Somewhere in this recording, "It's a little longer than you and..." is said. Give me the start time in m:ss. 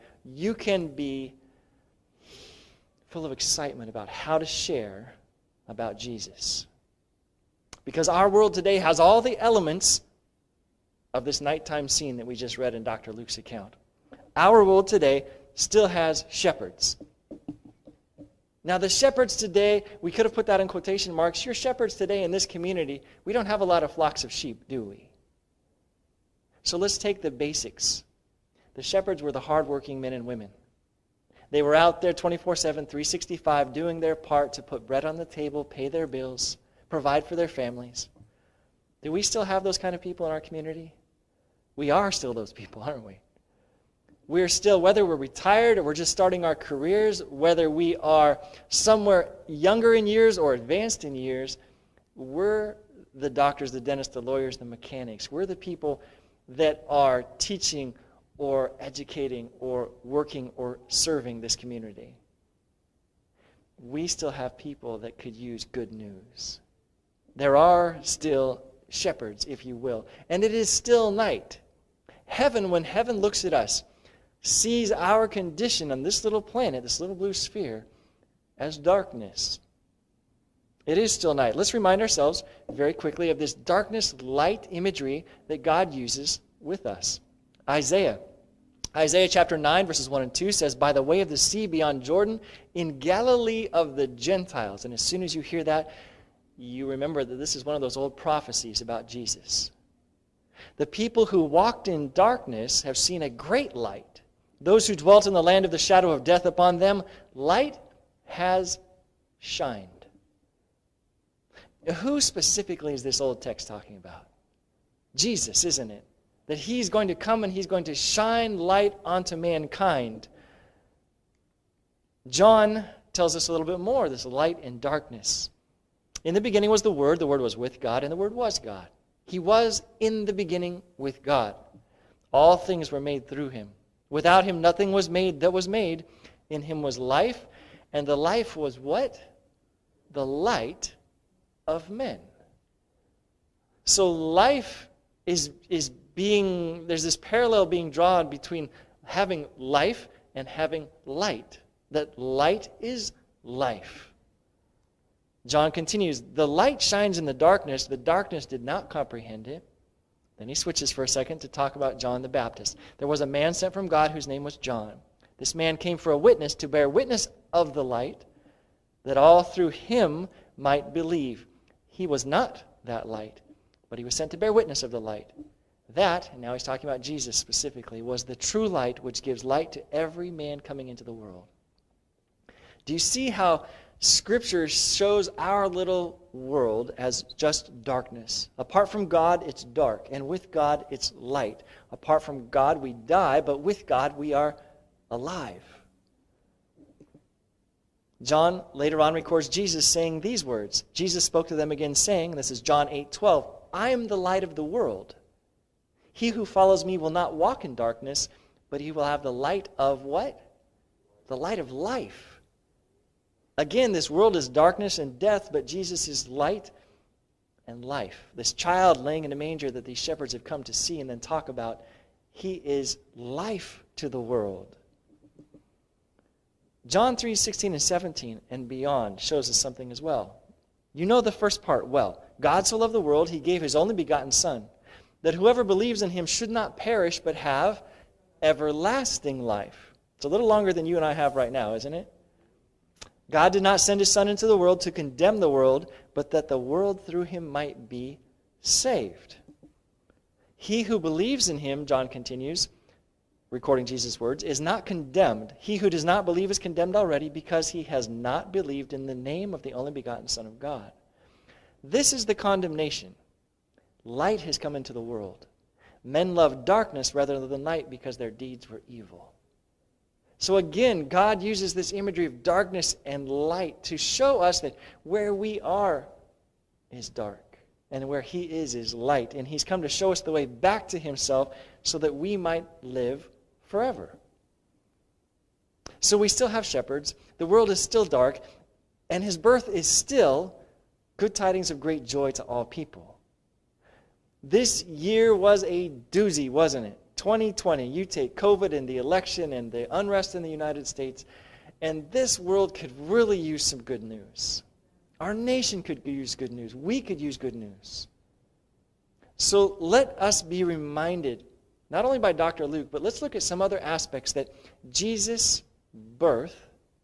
4:00.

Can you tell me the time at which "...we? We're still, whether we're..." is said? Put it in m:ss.
0:43.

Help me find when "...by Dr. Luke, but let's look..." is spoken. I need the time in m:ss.
5:12.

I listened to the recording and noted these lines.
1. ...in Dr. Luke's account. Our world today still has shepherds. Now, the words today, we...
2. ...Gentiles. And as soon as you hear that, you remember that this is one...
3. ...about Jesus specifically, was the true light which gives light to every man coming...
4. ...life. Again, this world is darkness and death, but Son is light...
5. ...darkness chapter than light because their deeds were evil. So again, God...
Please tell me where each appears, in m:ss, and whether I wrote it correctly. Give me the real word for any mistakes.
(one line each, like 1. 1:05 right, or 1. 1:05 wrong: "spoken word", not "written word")
1. 0:12 wrong: "shepherds", not "words"
2. 1:34 right
3. 2:56 right
4. 3:31 wrong: "Jesus", not "Son"
5. 4:26 wrong: "rather", not "chapter".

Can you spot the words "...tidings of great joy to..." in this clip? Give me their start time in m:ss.
4:51.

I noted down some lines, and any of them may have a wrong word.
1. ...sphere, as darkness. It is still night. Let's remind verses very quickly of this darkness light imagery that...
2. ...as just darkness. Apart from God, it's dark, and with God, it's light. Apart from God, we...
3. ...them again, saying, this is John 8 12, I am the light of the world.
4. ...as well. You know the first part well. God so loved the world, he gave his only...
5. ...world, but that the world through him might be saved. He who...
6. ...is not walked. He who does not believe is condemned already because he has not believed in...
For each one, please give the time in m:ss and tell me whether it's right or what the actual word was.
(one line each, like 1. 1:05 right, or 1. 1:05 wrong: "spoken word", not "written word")
1. 1:17 wrong: "ourselves", not "verses"
2. 3:06 right
3. 3:21 right
4. 3:49 right
5. 4:05 right
6. 4:14 wrong: "condemned", not "walked".